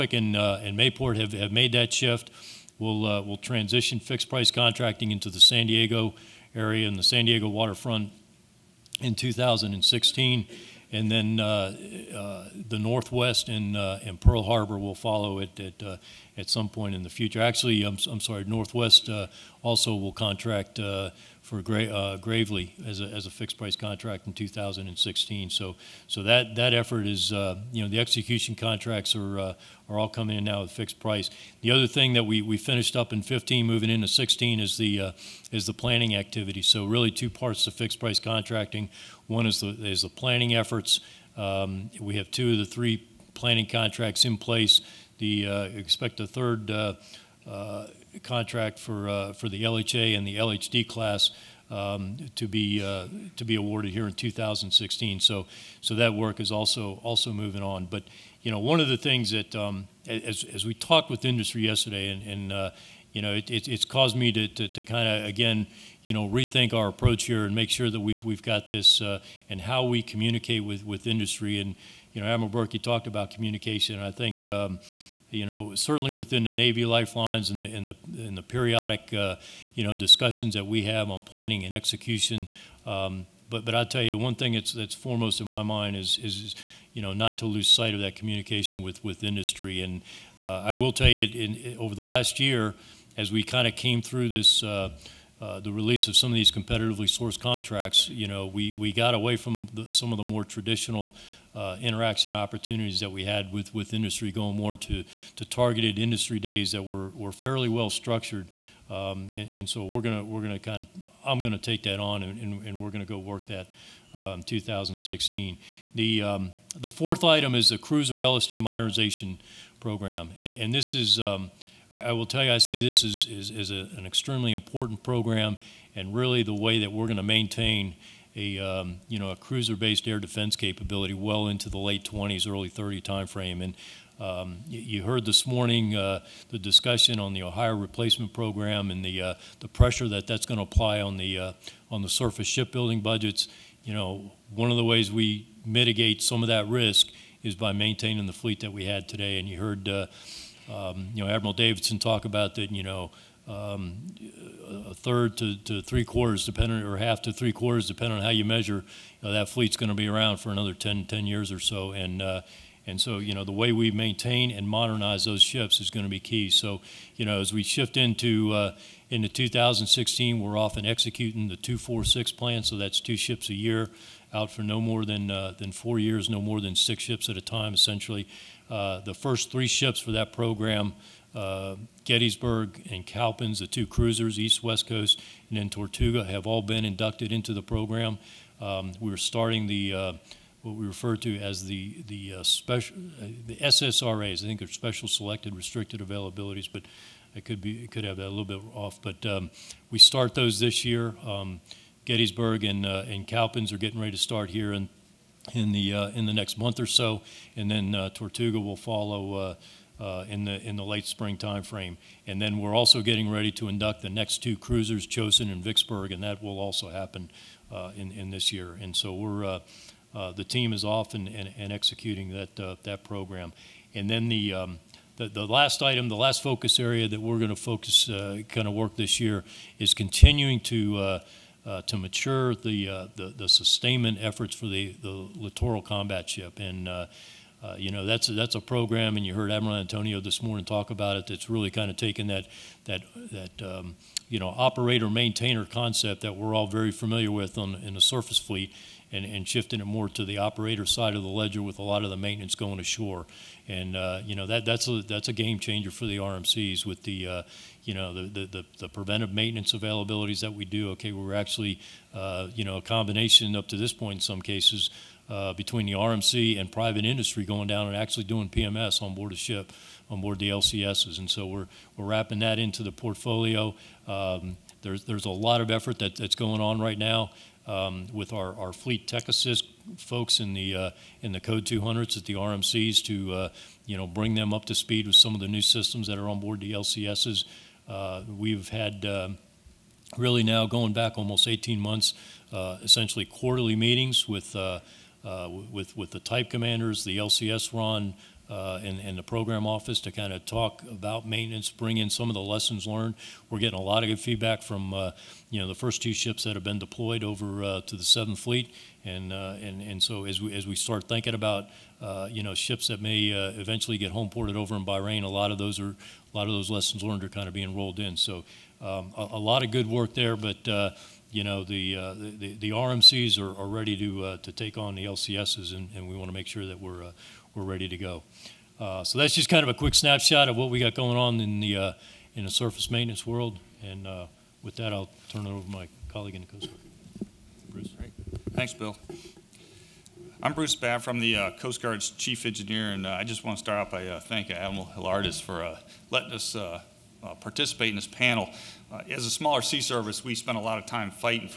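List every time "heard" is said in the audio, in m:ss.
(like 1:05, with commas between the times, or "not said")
2:15, 2:29, 3:59.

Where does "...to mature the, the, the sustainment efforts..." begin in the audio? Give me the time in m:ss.
3:51.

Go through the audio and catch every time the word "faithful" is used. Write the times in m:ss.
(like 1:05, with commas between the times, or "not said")
not said.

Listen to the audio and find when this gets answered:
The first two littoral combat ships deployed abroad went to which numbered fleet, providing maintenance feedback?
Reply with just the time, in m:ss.
5:08.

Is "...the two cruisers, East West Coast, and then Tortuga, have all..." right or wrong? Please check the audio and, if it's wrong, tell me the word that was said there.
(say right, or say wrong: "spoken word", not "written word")
right.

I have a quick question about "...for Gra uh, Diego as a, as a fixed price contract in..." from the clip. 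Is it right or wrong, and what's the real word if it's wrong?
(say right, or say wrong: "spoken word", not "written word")
wrong: "Gravely", not "Diego".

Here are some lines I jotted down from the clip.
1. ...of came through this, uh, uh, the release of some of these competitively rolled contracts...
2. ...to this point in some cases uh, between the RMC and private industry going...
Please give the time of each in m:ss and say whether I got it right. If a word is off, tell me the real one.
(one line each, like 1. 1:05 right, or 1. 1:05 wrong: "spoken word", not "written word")
1. 1:33 wrong: "sourced", not "rolled"
2. 4:23 right.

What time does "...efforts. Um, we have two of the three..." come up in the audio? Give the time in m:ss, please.
0:40.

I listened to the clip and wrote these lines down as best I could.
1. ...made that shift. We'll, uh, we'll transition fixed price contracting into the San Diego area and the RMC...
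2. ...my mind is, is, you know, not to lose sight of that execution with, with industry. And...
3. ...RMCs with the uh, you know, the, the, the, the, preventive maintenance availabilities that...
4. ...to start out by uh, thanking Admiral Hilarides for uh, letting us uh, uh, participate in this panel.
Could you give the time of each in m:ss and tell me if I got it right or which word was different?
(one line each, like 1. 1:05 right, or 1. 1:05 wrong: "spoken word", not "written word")
1. 0:01 wrong: "San", not "RMC"
2. 1:25 wrong: "communication", not "execution"
3. 4:16 right
4. 5:43 right.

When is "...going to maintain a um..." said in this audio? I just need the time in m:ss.
2:07.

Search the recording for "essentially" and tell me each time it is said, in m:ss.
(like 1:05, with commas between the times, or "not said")
2:57, 4:52.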